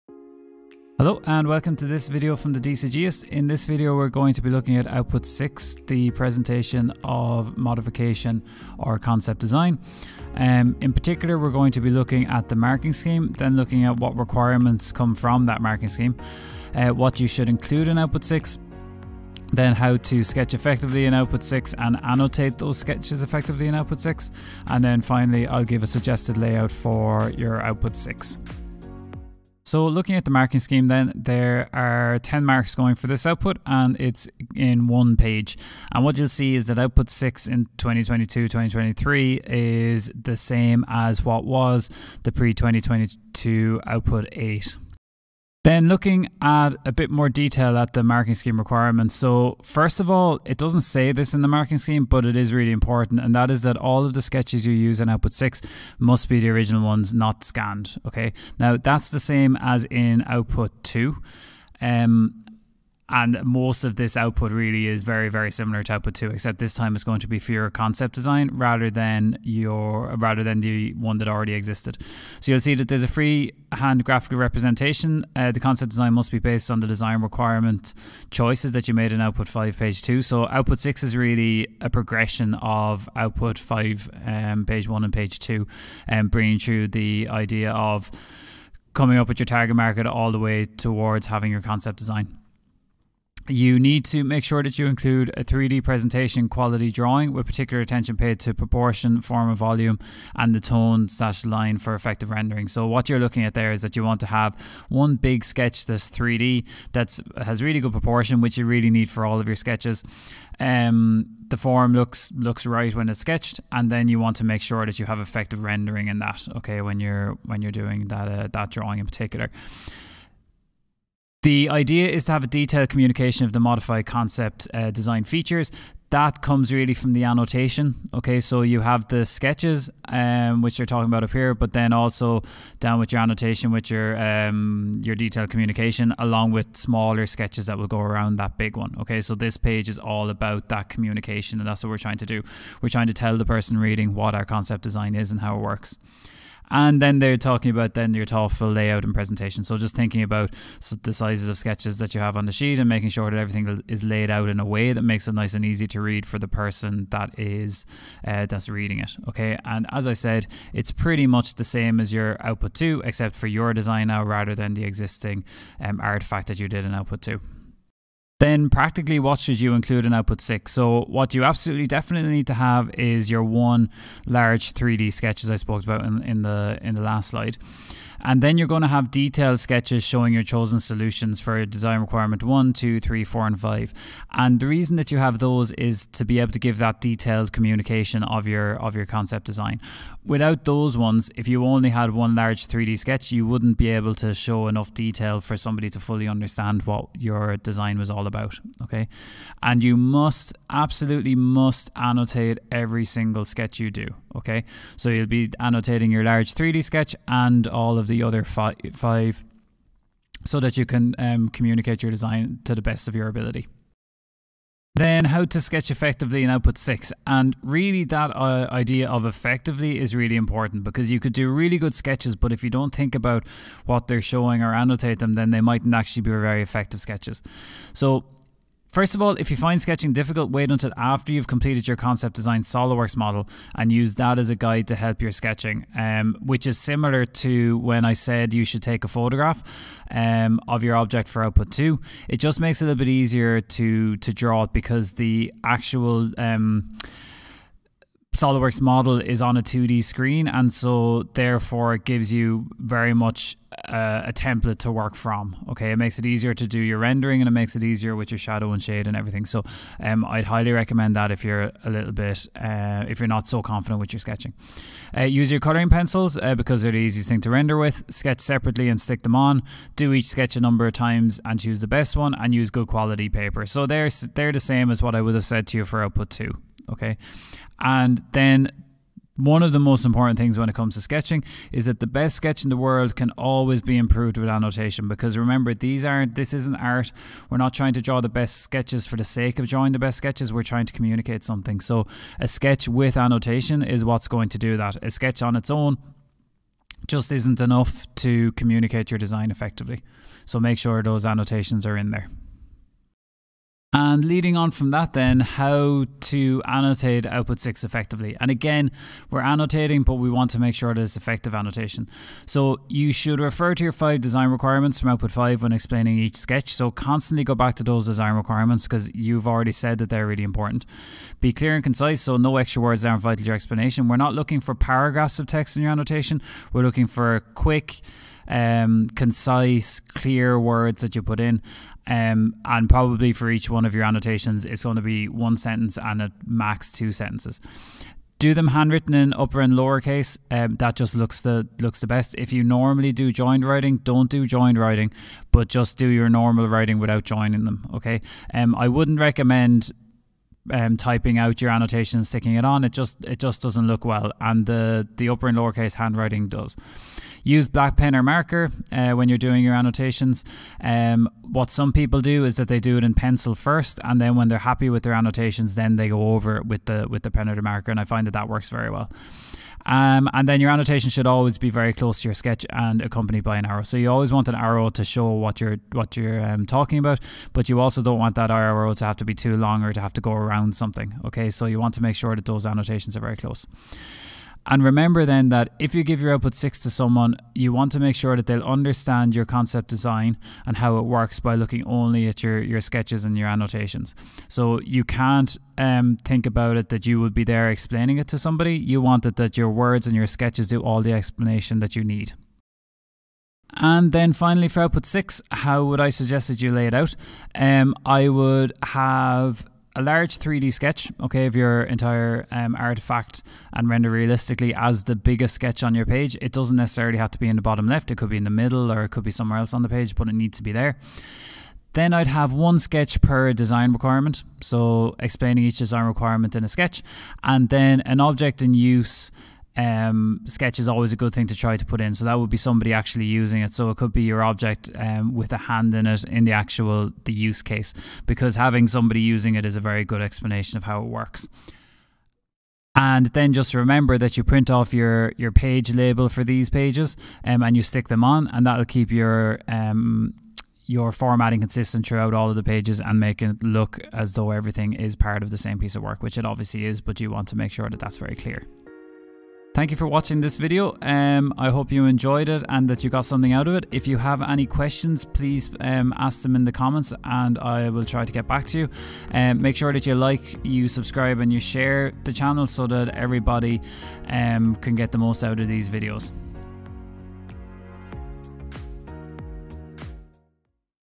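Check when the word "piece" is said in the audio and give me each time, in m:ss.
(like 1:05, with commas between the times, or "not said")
7:35.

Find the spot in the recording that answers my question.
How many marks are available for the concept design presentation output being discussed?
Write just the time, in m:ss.
0:32.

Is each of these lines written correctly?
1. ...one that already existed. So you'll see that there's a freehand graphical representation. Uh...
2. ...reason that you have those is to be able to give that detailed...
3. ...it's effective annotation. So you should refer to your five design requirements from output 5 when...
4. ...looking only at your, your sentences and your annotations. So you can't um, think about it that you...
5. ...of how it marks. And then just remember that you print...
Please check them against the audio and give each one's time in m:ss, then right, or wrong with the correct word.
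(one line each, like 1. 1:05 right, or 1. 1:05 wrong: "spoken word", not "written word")
1. 1:10 right
2. 3:04 right
3. 5:11 right
4. 6:31 wrong: "sketches", not "sentences"
5. 7:20 wrong: "works", not "marks".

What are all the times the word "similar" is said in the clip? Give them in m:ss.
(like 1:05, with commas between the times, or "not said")
1:05, 3:56.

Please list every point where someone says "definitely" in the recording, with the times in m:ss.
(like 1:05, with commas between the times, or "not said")
2:51.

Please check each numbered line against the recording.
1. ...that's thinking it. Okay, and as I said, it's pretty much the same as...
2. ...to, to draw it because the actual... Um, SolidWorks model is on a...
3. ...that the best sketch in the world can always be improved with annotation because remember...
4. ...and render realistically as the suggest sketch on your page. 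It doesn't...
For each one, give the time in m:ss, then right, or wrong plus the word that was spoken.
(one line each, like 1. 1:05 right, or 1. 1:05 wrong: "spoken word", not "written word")
1. 2:38 wrong: "reading", not "thinking"
2. 4:03 right
3. 4:41 right
4. 6:53 wrong: "biggest", not "suggest".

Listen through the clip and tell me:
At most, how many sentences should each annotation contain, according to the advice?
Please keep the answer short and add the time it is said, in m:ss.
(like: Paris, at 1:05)
2, at 5:36.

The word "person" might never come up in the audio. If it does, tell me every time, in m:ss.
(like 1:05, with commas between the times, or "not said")
2:23, 2:36.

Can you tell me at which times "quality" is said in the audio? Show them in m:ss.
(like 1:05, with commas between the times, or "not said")
1:36, 4:32.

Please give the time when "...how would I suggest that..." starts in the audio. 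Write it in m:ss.
6:45.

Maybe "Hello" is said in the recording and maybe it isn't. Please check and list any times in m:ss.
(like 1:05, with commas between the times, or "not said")
0:01.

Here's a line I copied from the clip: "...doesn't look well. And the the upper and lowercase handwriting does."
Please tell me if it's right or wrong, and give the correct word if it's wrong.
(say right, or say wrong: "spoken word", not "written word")
right.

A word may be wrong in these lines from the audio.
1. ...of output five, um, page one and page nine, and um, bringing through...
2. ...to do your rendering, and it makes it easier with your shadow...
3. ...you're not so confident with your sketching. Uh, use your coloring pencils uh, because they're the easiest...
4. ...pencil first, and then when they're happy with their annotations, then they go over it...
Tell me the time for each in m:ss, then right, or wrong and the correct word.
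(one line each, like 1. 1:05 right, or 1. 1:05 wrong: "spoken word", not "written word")
1. 1:22 wrong: "two", not "nine"
2. 4:16 right
3. 4:23 right
4. 6:03 right.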